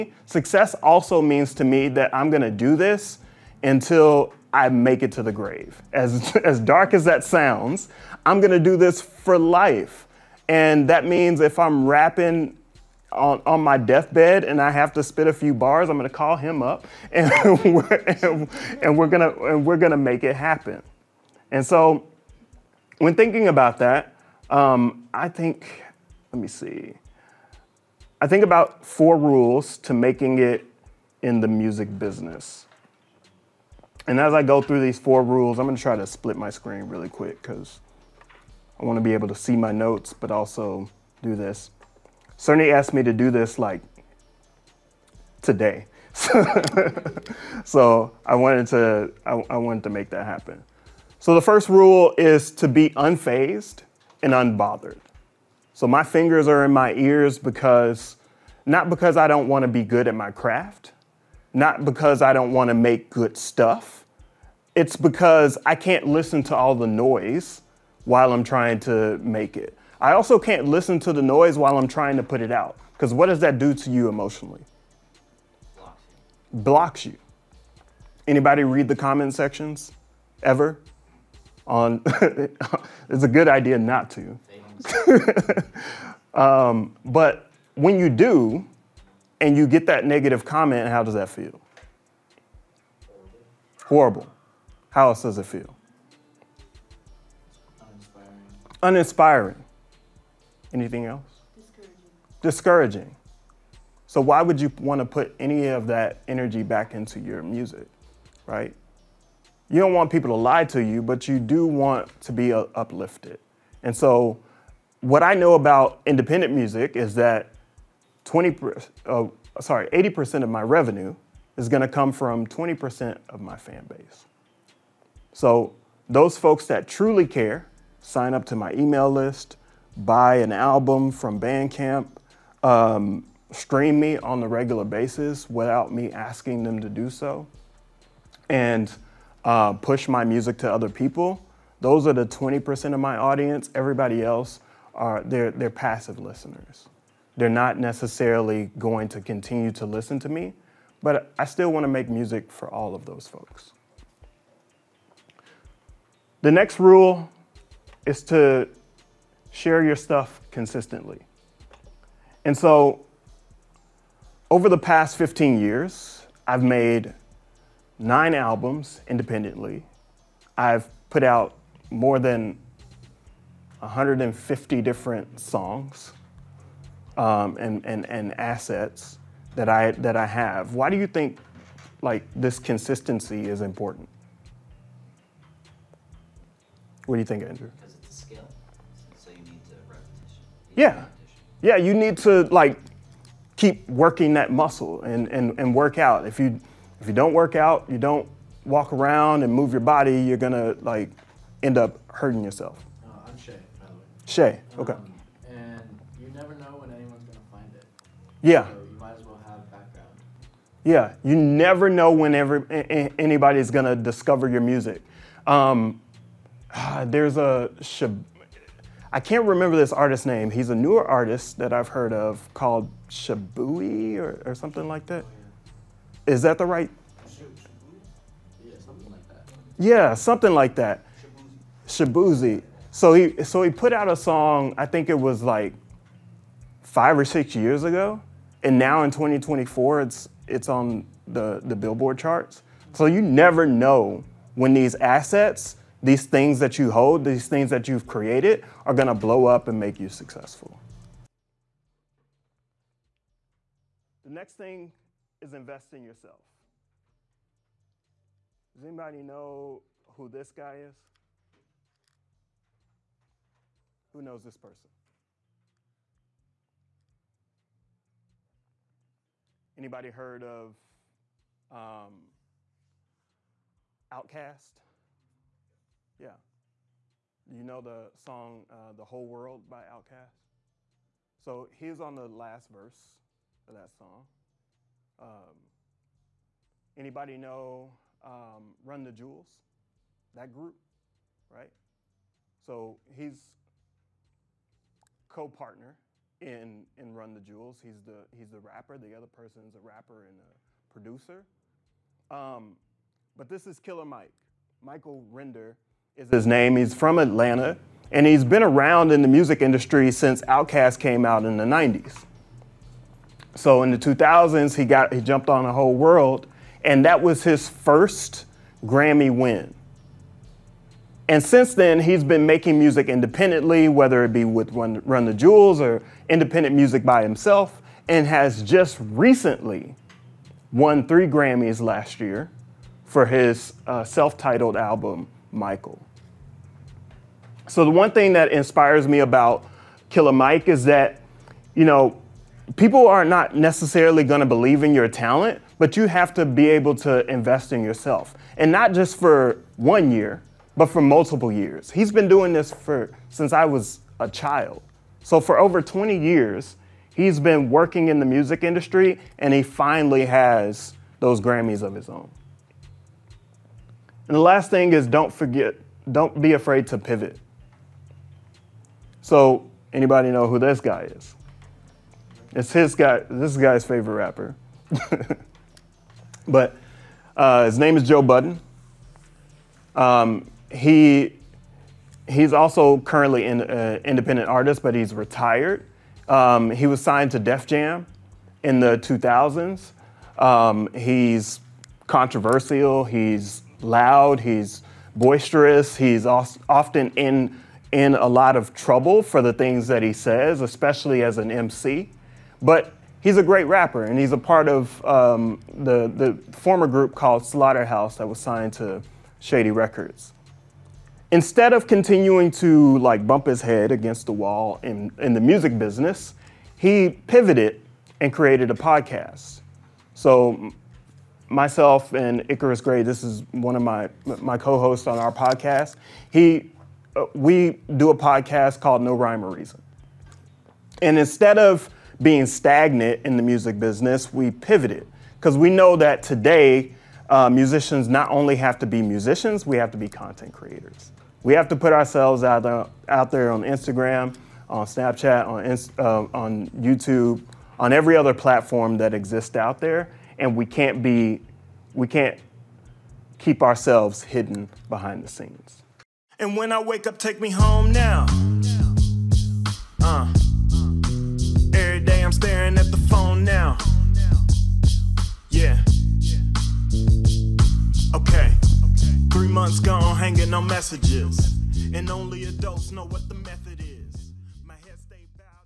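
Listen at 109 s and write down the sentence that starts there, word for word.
You don't want people to lie to you, but you do want to be uh, uplifted.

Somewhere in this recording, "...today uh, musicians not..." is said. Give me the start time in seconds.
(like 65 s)
436 s.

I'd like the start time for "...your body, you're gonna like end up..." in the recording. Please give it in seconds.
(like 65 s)
199 s.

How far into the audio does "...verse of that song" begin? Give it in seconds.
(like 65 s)
282 s.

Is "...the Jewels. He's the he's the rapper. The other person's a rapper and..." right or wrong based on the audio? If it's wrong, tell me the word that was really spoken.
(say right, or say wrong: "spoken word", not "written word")
right.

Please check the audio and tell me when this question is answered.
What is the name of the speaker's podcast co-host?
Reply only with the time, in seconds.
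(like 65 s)
422 s.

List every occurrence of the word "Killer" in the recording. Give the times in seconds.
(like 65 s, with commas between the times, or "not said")
303 s, 340 s.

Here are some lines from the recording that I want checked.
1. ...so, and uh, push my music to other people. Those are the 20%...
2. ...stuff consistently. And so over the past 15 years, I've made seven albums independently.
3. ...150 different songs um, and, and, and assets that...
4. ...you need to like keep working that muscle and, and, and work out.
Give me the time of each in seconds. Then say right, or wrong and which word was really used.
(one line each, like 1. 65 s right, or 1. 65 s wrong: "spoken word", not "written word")
1. 137 s right
2. 159 s wrong: "nine", not "seven"
3. 173 s right
4. 191 s right.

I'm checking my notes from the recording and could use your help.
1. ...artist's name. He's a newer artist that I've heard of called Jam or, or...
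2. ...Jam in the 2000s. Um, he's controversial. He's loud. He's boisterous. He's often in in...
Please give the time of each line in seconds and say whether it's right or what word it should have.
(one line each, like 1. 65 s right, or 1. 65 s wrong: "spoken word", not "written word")
1. 219 s wrong: "Shabui", not "Jam"
2. 387 s right.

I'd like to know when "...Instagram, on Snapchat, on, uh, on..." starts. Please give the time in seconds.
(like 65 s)
443 s.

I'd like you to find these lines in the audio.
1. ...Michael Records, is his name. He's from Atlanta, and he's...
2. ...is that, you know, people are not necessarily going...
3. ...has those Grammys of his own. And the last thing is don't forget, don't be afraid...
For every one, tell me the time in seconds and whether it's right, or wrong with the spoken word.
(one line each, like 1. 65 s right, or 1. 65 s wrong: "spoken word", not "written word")
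1. 304 s wrong: "Render", not "Records"
2. 340 s right
3. 360 s right.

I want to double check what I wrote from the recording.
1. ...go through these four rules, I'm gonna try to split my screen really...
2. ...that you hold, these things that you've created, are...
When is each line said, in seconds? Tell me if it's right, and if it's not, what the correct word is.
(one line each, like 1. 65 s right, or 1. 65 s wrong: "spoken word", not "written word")
1. 34 s right
2. 246 s right.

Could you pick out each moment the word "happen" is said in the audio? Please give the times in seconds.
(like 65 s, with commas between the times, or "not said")
20 s, 50 s.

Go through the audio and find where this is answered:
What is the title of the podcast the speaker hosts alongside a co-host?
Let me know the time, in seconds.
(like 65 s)
429 s.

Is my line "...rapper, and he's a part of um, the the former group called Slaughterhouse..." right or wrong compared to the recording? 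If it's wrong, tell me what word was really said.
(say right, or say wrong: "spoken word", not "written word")
right.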